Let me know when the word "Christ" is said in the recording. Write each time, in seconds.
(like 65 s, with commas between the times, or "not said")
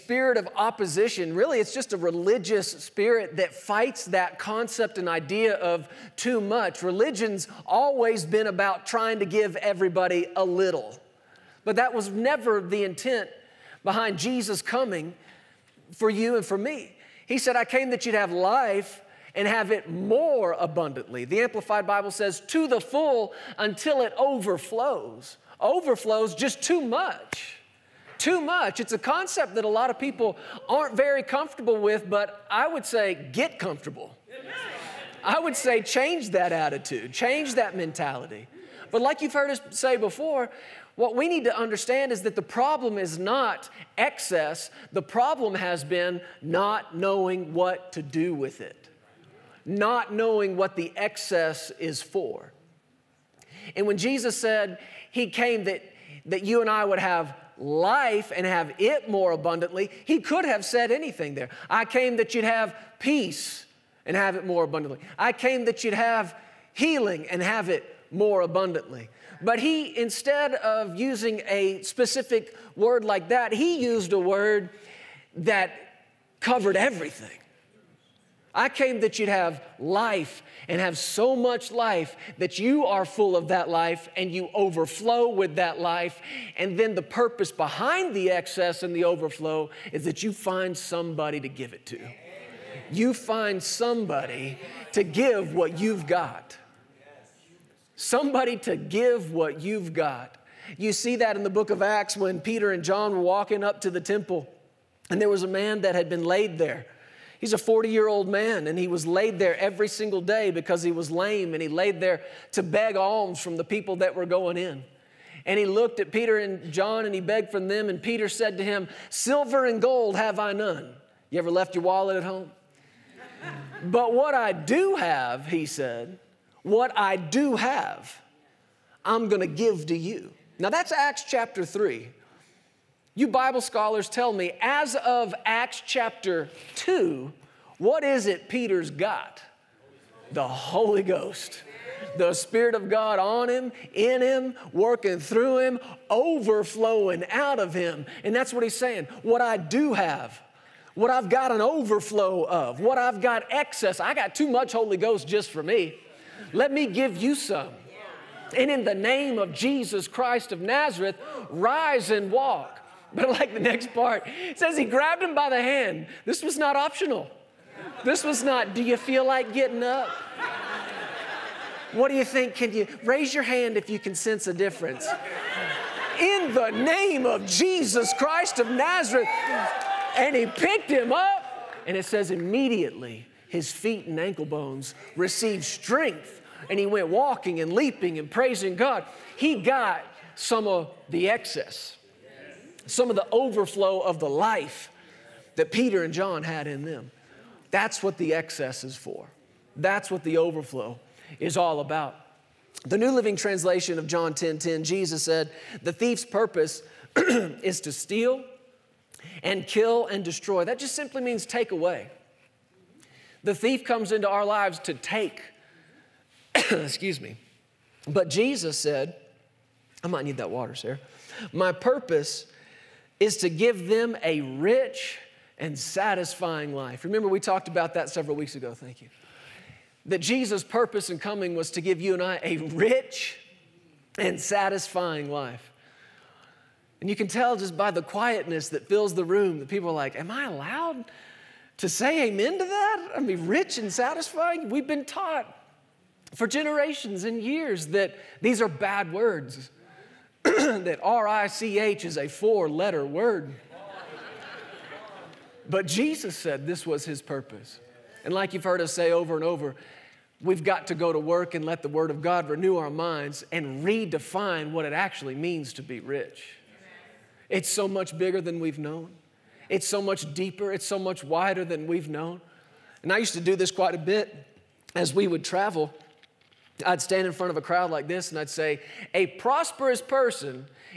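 160 s, 178 s.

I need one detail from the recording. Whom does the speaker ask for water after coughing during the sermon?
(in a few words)
Sarah.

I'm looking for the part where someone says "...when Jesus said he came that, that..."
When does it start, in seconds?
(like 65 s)
53 s.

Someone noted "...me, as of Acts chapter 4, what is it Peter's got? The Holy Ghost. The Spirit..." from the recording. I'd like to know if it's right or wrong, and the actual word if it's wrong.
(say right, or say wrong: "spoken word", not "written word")
wrong: "2", not "4".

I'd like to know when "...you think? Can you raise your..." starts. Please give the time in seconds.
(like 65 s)
172 s.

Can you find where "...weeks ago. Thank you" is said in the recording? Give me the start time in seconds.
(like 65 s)
228 s.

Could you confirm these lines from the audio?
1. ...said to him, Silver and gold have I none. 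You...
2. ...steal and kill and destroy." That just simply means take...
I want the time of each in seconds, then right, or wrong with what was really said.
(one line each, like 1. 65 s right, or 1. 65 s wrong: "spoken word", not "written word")
1. 118 s right
2. 207 s right.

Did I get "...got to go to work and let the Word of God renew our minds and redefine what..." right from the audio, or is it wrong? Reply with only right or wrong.
right.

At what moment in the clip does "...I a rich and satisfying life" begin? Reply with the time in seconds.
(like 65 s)
232 s.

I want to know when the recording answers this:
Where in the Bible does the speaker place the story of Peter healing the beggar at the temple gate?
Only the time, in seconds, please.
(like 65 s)
130 s.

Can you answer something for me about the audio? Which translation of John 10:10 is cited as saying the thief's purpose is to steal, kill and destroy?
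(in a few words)
New Living Translation.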